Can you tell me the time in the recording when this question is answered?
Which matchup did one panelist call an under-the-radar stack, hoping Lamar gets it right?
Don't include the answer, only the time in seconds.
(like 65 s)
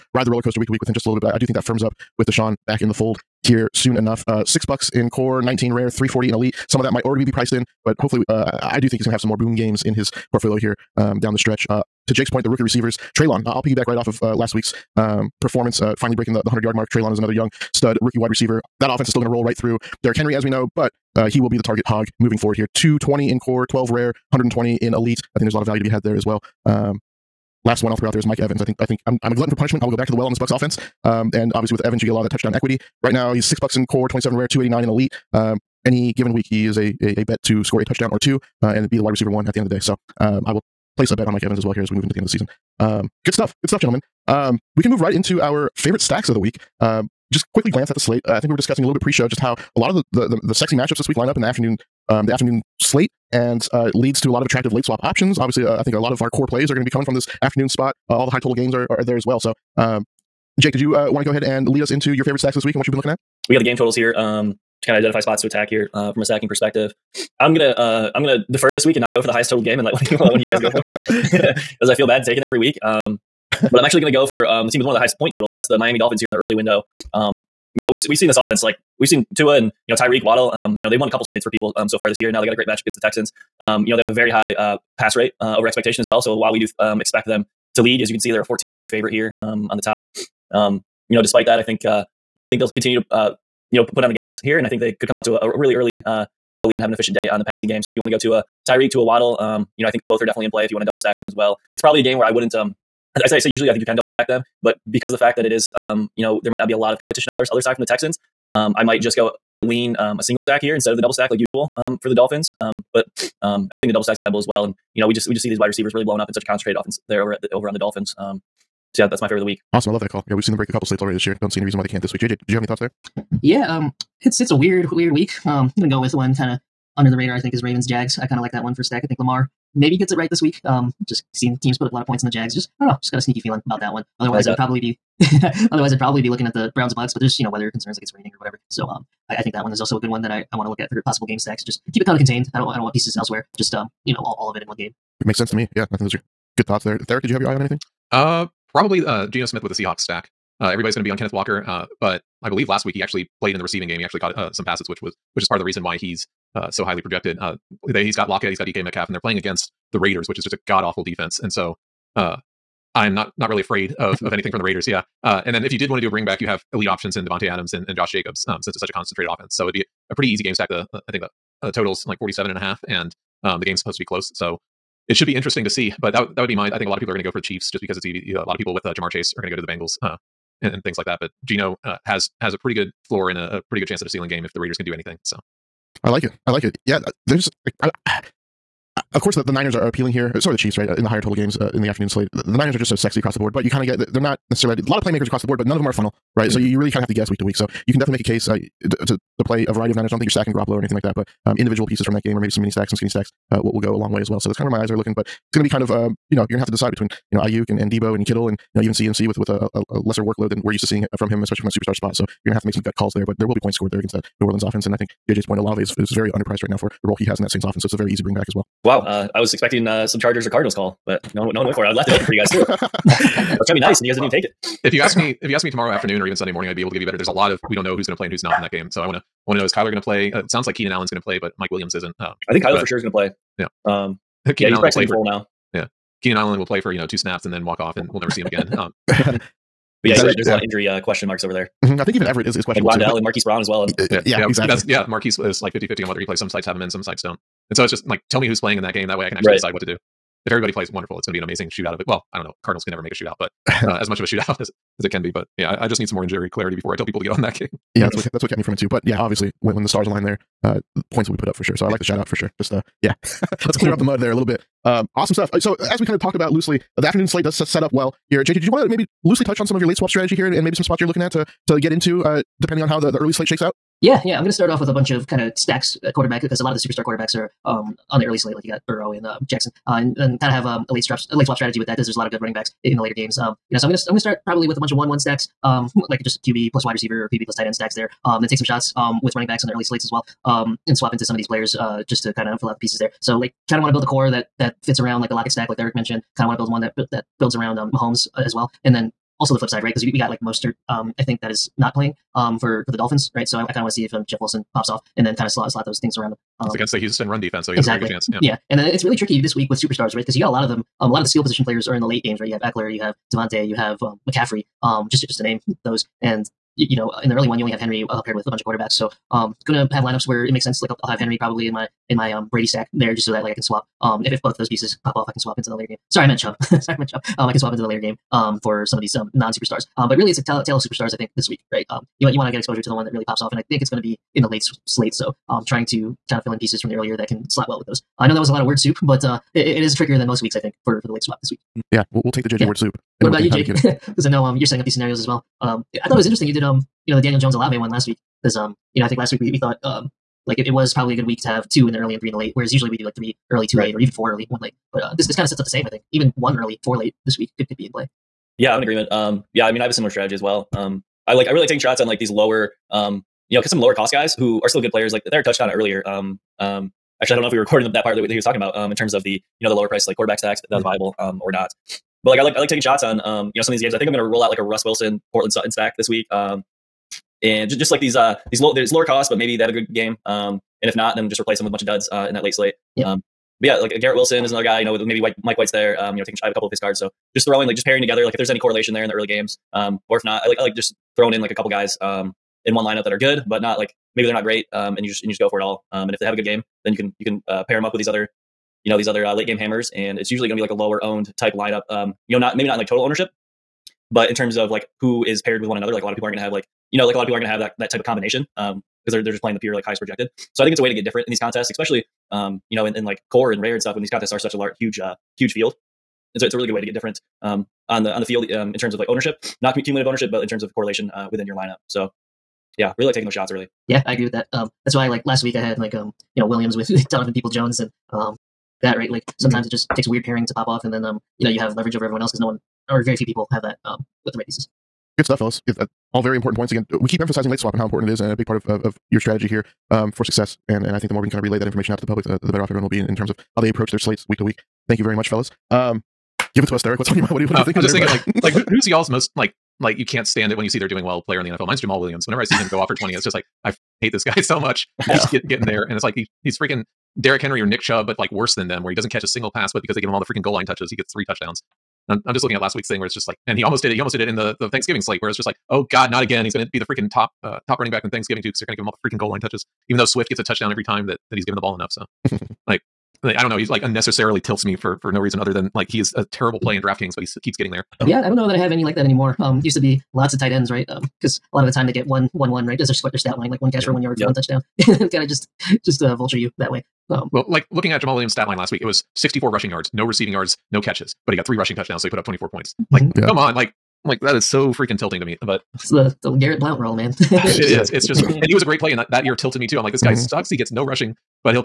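127 s.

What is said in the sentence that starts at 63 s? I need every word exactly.
we got the game totals here um, to kind of identify spots to attack here uh, from a stacking perspective.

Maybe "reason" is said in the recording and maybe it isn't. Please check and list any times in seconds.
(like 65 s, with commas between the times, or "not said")
121 s, 155 s, 475 s.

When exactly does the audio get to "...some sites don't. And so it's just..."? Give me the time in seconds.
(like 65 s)
246 s.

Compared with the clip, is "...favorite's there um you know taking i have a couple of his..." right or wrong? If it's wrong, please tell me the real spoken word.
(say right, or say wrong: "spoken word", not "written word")
wrong: "white", not "favorite".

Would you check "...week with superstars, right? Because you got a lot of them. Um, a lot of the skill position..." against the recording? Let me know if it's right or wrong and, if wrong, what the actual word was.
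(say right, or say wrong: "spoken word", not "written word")
right.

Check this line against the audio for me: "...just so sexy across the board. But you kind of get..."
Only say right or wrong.
right.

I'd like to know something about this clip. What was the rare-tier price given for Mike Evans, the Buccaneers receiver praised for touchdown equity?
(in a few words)
27.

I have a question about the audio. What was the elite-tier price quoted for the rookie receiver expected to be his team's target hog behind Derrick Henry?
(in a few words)
120.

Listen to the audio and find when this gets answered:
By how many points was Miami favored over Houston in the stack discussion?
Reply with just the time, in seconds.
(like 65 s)
88 s.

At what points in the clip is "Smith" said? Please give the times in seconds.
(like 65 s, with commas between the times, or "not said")
149 s.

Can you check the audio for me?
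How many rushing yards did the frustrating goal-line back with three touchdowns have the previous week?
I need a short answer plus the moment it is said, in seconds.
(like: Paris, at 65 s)
64, at 489 s.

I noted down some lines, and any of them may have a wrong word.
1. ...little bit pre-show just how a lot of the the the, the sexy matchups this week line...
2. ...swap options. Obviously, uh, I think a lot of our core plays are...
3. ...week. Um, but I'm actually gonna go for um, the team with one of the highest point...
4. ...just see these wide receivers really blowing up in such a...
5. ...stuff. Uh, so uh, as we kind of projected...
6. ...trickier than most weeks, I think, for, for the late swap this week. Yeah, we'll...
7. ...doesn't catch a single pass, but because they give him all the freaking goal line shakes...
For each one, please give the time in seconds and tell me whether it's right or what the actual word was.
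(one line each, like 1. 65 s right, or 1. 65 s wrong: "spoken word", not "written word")
1. 48 s right
2. 54 s right
3. 72 s right
4. 115 s right
5. 265 s wrong: "talked", not "projected"
6. 339 s right
7. 458 s wrong: "touches", not "shakes".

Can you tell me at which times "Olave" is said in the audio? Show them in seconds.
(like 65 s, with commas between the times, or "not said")
215 s, 347 s.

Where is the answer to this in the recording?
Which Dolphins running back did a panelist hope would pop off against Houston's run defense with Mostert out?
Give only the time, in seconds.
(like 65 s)
304 s.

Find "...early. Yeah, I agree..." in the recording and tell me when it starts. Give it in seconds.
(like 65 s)
423 s.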